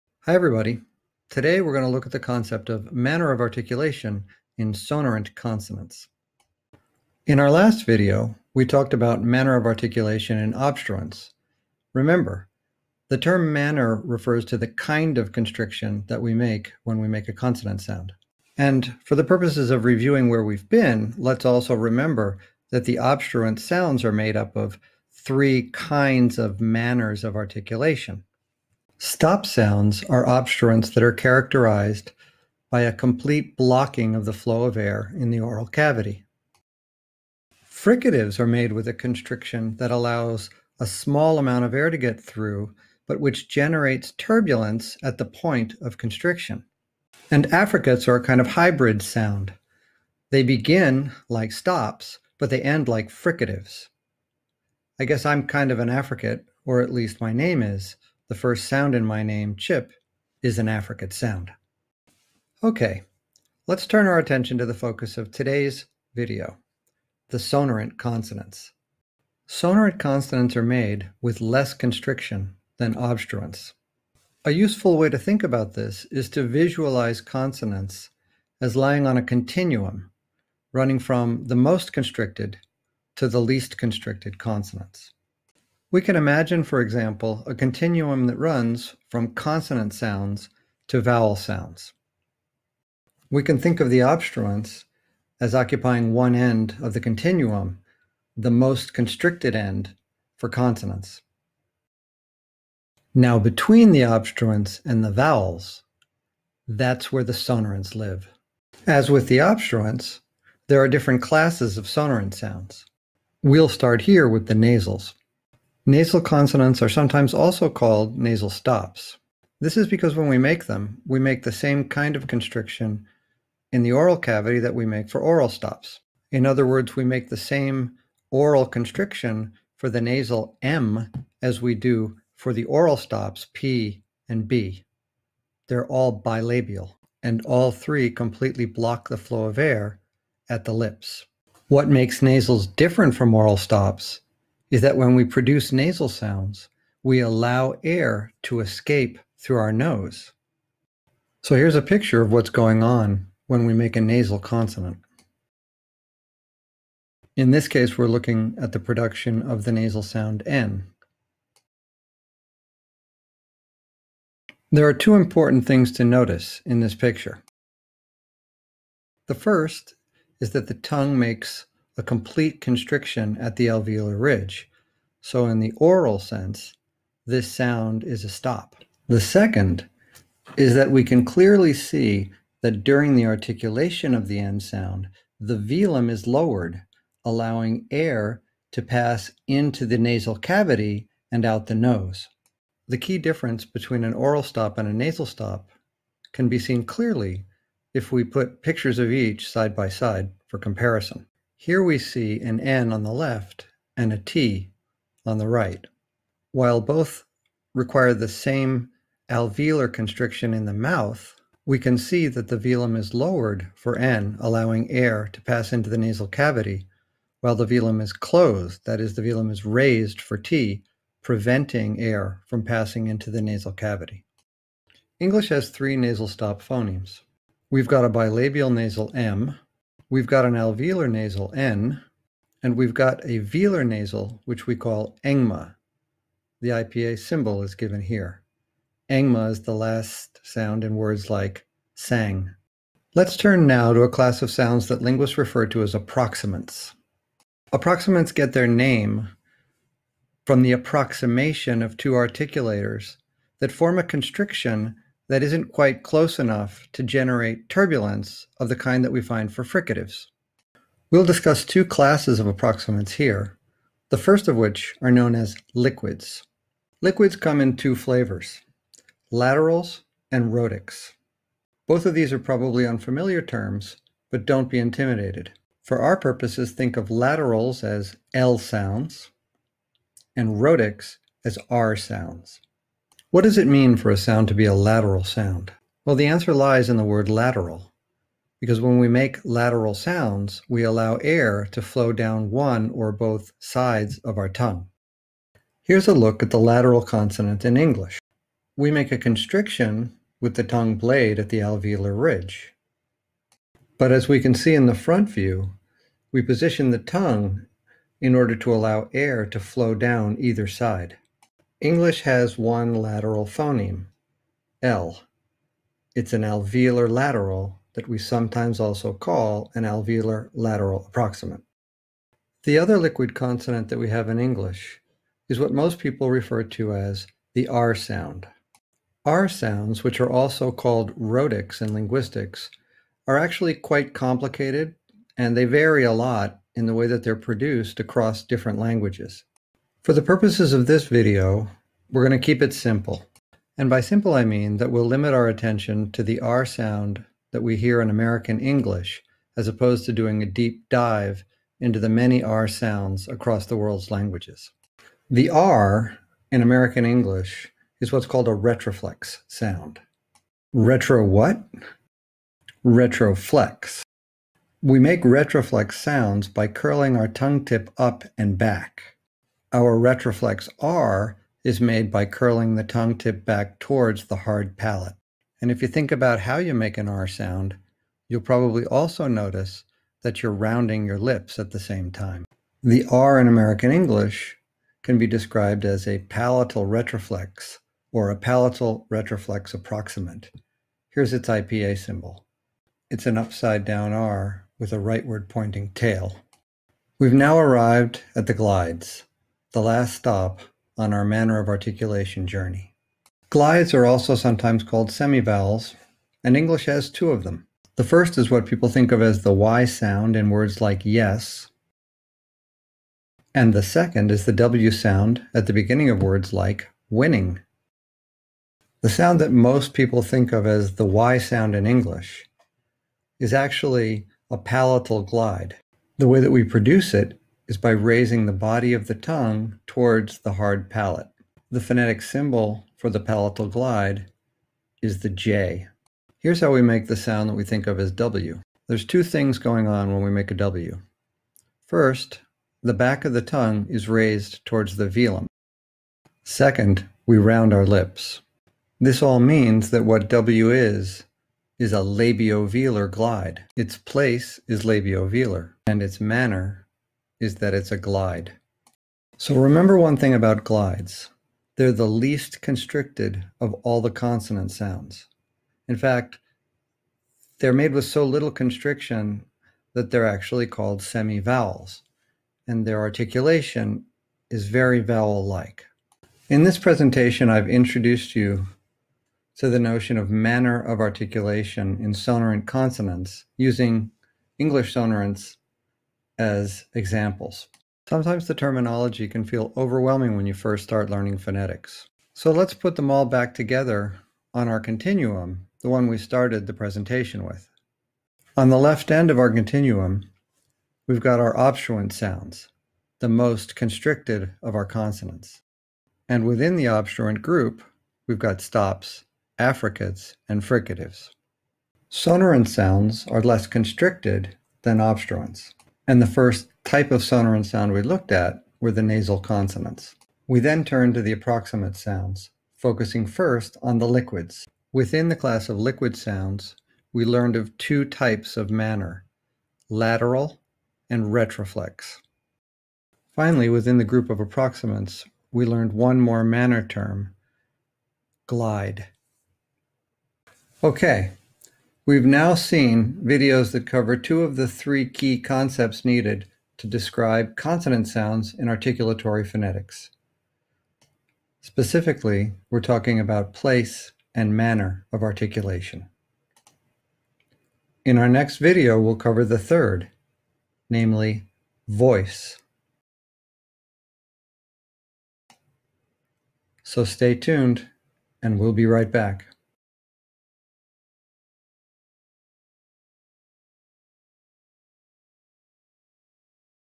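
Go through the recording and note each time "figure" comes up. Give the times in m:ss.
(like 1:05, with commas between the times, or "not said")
not said.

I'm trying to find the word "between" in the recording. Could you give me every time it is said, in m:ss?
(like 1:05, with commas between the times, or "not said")
1:43, 3:13.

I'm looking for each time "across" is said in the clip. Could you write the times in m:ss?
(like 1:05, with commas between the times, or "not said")
5:37, 5:53.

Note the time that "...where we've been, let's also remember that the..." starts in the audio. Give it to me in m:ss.
0:20.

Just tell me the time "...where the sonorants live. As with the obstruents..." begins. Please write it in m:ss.
1:47.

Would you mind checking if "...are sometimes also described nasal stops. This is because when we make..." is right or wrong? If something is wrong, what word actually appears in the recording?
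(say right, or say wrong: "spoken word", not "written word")
wrong: "called", not "described".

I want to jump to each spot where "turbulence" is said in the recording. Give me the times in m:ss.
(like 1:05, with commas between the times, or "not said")
0:44, 4:17.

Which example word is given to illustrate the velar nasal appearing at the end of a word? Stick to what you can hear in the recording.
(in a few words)
sang.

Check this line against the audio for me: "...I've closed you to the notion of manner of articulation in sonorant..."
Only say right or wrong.
wrong.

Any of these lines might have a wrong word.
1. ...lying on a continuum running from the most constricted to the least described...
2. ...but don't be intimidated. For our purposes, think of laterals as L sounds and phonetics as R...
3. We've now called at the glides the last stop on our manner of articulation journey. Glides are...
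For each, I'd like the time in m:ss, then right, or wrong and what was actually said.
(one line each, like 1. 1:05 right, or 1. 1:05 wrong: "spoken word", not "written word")
1. 1:18 wrong: "constricted", not "described"
2. 4:34 wrong: "rhotics", not "phonetics"
3. 6:37 wrong: "arrived", not "called".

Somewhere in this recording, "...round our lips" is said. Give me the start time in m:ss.
7:27.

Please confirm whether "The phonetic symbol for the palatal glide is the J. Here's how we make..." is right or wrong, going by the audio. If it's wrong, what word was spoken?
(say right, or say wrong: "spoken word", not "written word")
right.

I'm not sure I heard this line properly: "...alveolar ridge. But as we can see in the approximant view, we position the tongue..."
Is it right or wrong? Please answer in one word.
wrong.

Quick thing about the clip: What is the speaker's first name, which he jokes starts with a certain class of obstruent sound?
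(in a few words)
Chip.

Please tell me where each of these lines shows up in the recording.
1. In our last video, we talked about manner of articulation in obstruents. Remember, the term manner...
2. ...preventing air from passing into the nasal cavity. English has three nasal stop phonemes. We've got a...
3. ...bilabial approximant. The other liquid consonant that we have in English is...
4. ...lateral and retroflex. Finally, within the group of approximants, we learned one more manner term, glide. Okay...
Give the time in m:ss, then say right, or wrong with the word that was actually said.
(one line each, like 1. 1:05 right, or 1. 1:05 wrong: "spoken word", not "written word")
1. 0:07 right
2. 3:41 right
3. 5:20 wrong: "lateral", not "bilabial"
4. 8:49 right.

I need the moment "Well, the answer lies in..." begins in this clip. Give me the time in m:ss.
4:46.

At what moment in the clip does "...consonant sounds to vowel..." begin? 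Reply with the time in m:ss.
1:29.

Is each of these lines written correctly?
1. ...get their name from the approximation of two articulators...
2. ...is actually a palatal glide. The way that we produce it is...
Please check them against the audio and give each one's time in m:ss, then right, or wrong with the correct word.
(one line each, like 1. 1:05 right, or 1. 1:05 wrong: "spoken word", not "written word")
1. 4:08 right
2. 7:03 right.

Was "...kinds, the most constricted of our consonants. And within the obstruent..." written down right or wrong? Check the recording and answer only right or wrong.
wrong.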